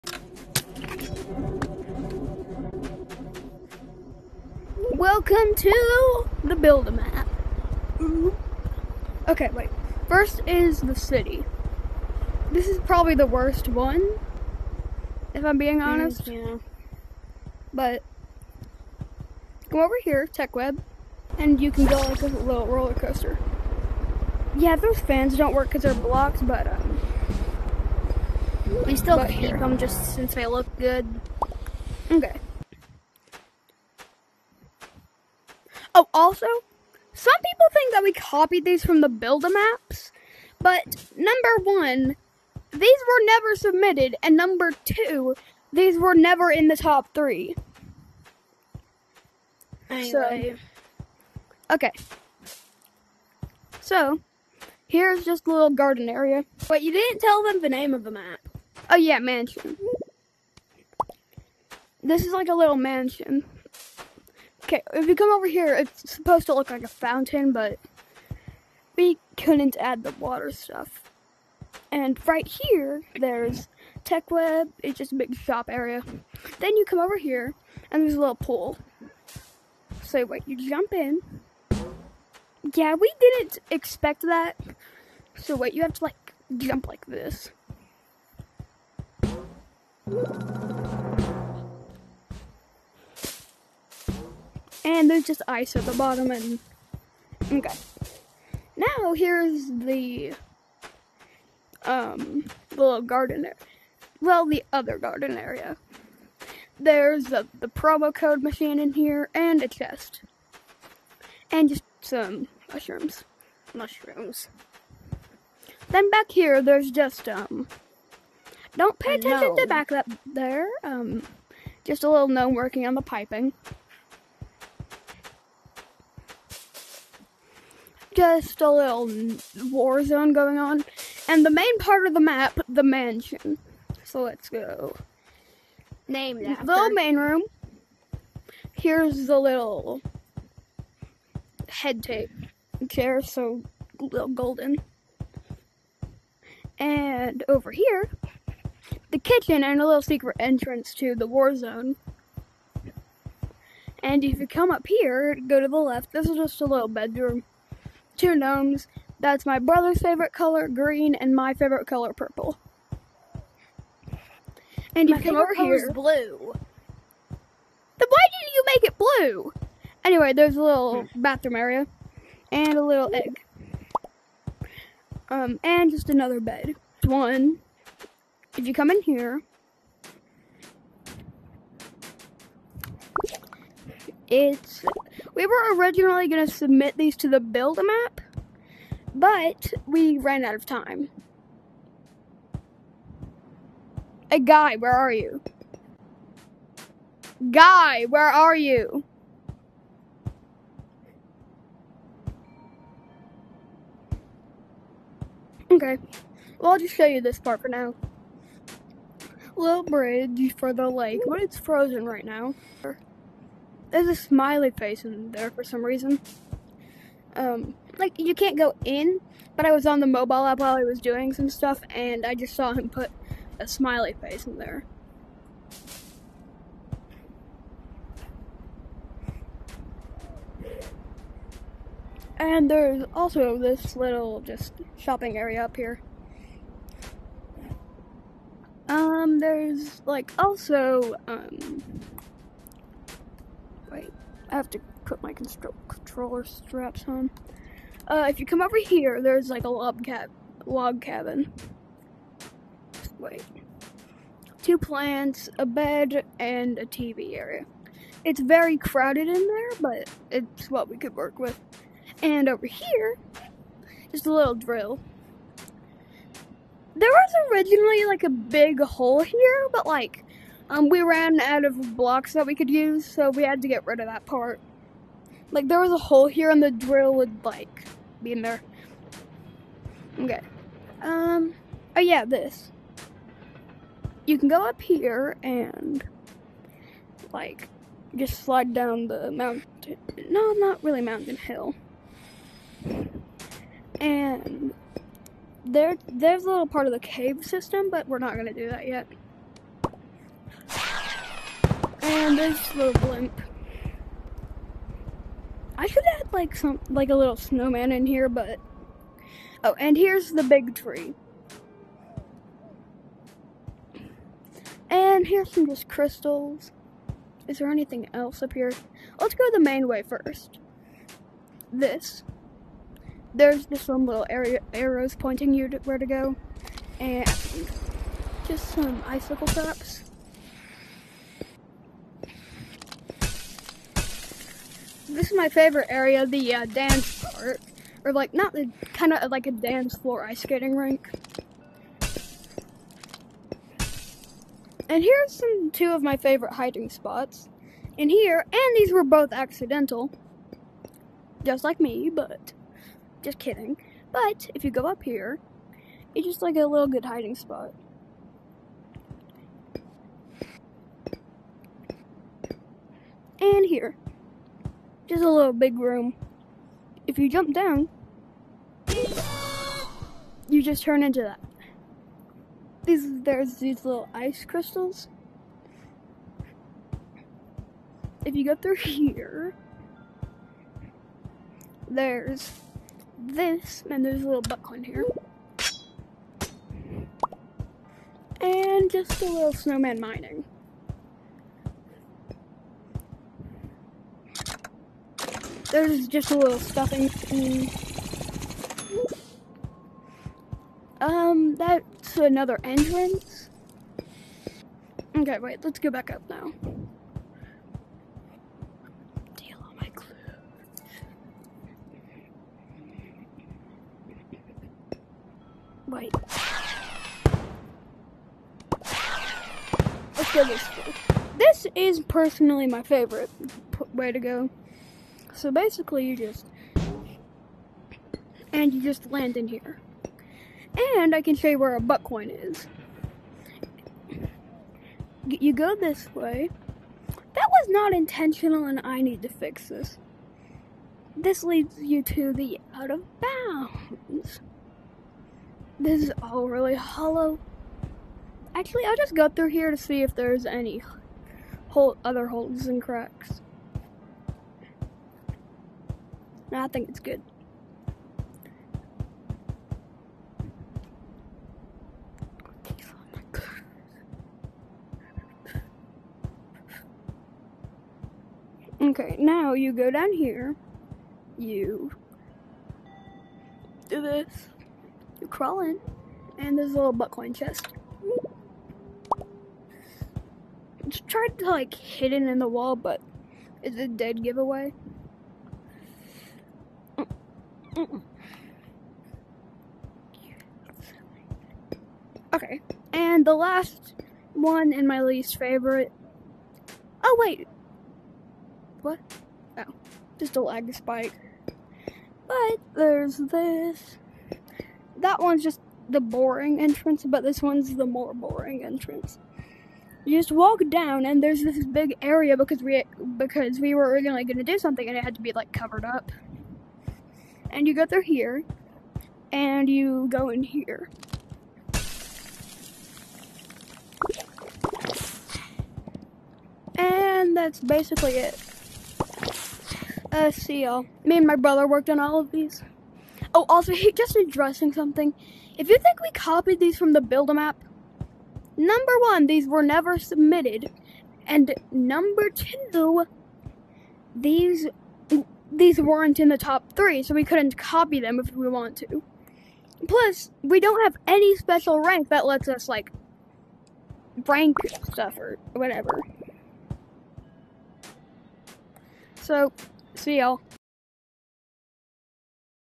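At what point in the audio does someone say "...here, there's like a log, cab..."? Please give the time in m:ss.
4:08.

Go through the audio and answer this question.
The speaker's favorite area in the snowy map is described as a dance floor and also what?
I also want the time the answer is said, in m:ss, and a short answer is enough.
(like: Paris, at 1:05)
Ice skating rink, at 5:40.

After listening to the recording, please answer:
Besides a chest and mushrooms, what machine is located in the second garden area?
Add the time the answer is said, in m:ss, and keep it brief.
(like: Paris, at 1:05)
Promo code machine, at 1:47.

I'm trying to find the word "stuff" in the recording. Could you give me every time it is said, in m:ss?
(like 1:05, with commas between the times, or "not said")
1:10, 3:41, 6:36, 9:14.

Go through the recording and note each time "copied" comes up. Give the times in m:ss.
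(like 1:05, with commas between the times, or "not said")
0:38, 8:56.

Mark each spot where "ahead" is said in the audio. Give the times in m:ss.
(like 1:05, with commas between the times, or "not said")
not said.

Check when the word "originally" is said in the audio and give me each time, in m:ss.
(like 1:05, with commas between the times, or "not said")
3:05, 4:27, 8:33.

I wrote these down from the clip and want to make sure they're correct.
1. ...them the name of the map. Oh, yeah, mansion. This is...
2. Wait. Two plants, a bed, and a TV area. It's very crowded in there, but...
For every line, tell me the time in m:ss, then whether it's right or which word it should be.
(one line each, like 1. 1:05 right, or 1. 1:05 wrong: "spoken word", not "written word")
1. 0:57 right
2. 4:13 right.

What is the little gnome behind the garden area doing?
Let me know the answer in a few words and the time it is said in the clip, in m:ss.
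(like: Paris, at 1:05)
Working on the piping, at 2:02.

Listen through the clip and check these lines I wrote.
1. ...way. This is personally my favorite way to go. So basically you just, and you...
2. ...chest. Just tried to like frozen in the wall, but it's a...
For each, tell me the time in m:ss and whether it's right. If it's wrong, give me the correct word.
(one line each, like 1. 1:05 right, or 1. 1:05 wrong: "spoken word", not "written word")
1. 7:00 right
2. 7:57 wrong: "hidden", not "frozen".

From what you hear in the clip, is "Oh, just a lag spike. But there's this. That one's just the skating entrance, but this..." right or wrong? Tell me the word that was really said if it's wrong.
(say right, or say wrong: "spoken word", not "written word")
wrong: "boring", not "skating".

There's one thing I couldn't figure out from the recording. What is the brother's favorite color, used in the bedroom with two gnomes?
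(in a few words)
Green.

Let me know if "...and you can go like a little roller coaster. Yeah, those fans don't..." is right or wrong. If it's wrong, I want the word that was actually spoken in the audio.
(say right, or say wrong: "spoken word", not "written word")
right.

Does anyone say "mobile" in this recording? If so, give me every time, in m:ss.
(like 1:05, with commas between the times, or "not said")
3:40.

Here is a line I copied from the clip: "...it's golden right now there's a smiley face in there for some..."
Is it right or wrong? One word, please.
wrong.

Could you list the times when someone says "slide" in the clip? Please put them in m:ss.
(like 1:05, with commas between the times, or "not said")
4:48.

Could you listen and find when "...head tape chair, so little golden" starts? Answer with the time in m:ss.
2:21.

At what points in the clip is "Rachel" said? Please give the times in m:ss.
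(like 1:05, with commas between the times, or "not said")
not said.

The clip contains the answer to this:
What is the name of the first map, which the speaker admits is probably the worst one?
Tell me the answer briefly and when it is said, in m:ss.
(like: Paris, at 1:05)
The city, at 0:10.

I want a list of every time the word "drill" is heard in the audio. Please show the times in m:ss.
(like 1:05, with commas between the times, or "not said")
4:24, 4:36.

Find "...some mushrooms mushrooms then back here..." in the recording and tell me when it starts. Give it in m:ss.
1:52.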